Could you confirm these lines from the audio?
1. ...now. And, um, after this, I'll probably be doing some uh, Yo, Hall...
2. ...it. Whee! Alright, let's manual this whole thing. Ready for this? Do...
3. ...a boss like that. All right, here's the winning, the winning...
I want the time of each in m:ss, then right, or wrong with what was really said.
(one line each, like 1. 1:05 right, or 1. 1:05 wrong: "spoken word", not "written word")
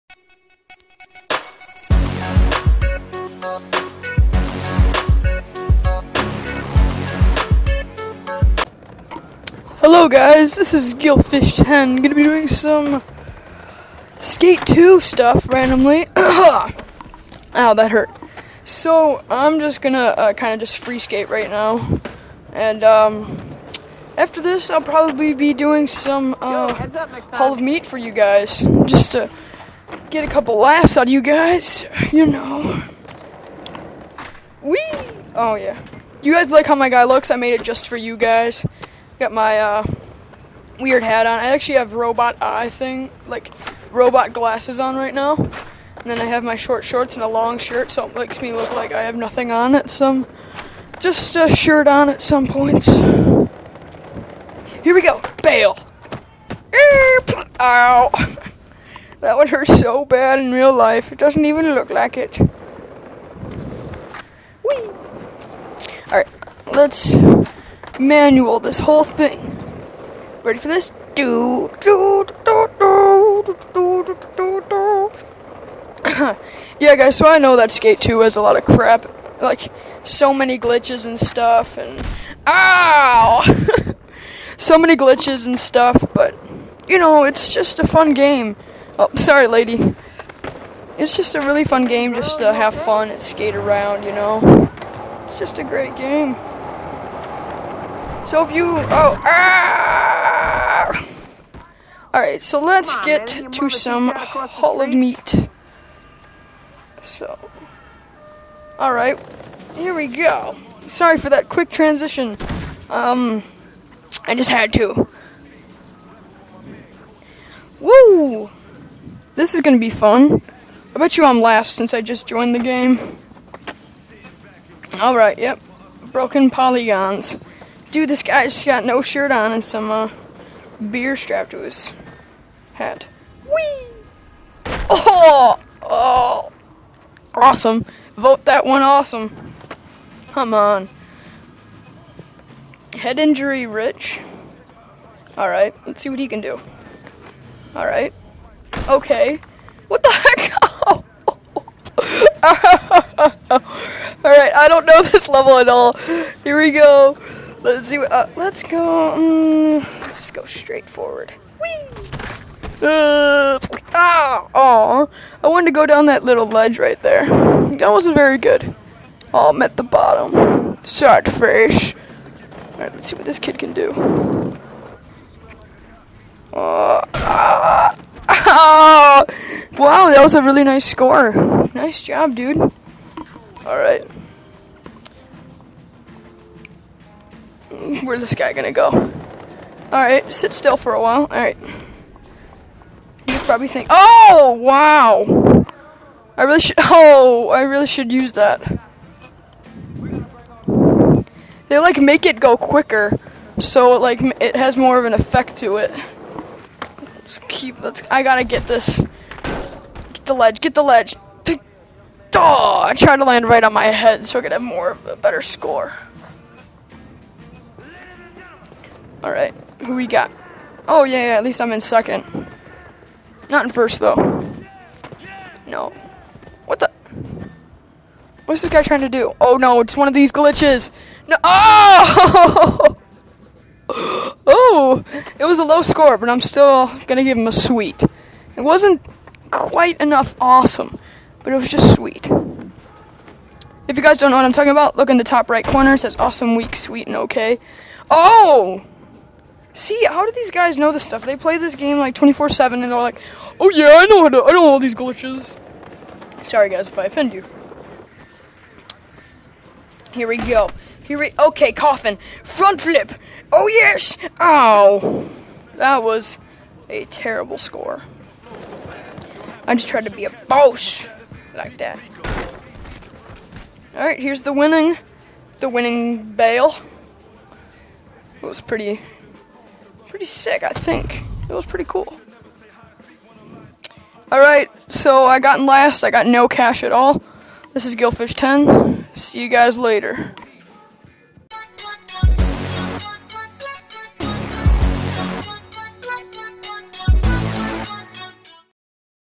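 1. 0:21 right
2. 1:02 right
3. 4:30 right.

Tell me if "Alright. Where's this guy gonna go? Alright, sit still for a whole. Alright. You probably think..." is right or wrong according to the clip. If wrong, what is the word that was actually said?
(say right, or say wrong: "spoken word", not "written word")
wrong: "while", not "whole".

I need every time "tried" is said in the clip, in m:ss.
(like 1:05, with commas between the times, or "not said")
3:32, 4:29.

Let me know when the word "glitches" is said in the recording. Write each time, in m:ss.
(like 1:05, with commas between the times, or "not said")
1:20, 1:24, 3:50, 4:14.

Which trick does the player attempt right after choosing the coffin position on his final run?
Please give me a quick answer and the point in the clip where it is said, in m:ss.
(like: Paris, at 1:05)
Front flip, at 4:22.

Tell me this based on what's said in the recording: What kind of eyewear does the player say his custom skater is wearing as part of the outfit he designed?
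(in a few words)
robot glasses.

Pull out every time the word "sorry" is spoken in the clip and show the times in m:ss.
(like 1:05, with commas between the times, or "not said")
1:29, 1:50, 4:16.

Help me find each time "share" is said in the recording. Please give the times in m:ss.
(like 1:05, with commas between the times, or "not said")
not said.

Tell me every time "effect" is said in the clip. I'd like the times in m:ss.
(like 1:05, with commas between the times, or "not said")
3:25.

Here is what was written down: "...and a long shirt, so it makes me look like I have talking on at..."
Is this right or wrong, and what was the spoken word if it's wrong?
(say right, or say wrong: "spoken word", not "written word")
wrong: "nothing", not "talking".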